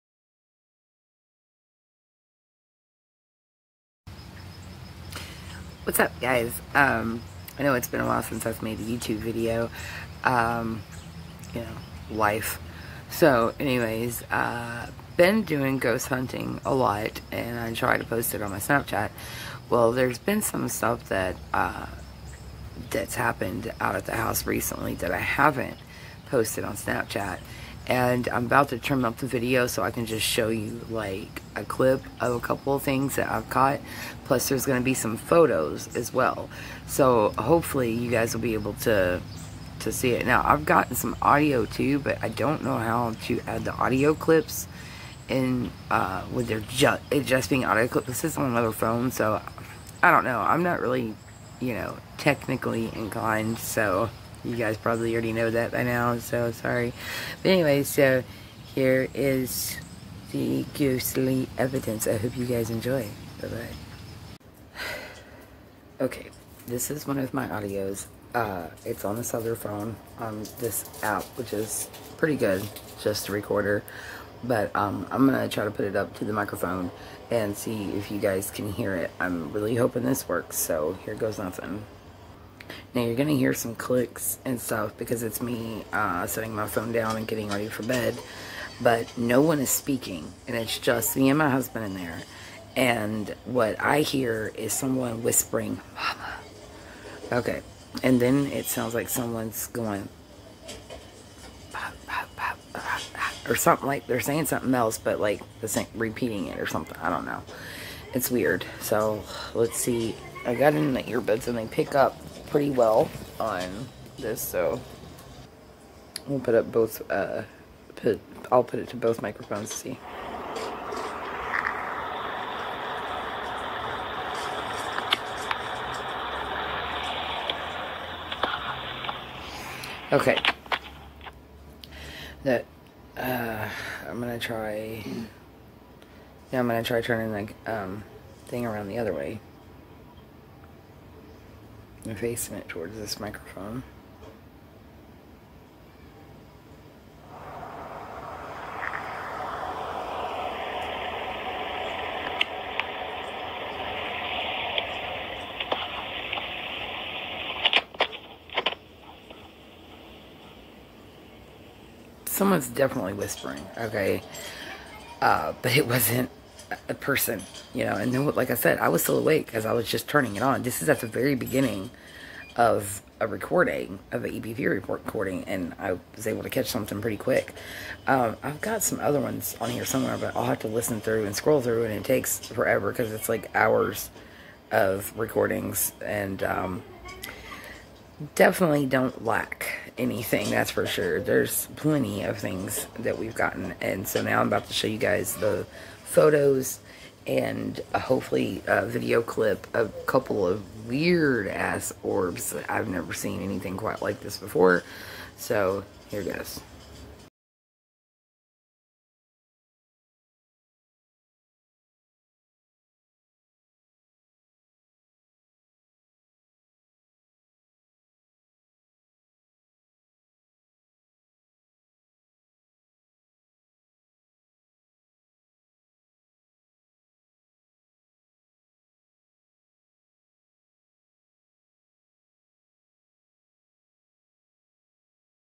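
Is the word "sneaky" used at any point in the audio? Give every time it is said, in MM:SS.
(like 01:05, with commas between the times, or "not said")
not said.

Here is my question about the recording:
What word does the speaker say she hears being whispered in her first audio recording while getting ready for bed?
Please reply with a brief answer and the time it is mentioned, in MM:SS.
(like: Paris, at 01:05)
Mama, at 01:35.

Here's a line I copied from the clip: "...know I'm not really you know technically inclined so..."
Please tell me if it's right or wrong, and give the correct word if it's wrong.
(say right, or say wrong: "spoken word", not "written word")
right.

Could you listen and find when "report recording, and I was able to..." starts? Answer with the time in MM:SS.
02:54.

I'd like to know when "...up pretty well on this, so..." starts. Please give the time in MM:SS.
01:51.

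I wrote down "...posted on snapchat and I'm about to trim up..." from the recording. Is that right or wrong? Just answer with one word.
right.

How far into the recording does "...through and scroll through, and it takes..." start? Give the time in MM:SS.
03:01.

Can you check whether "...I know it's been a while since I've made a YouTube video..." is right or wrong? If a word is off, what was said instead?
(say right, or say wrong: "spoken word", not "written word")
right.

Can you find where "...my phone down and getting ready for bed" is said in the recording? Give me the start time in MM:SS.
01:26.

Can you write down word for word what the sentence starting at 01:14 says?
But um, I'm going to try to put it up to the microphone and see if you guys can hear it.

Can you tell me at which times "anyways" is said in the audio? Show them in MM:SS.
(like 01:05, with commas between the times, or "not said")
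00:13, 00:57.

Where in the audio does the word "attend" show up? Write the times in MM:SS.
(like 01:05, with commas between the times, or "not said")
not said.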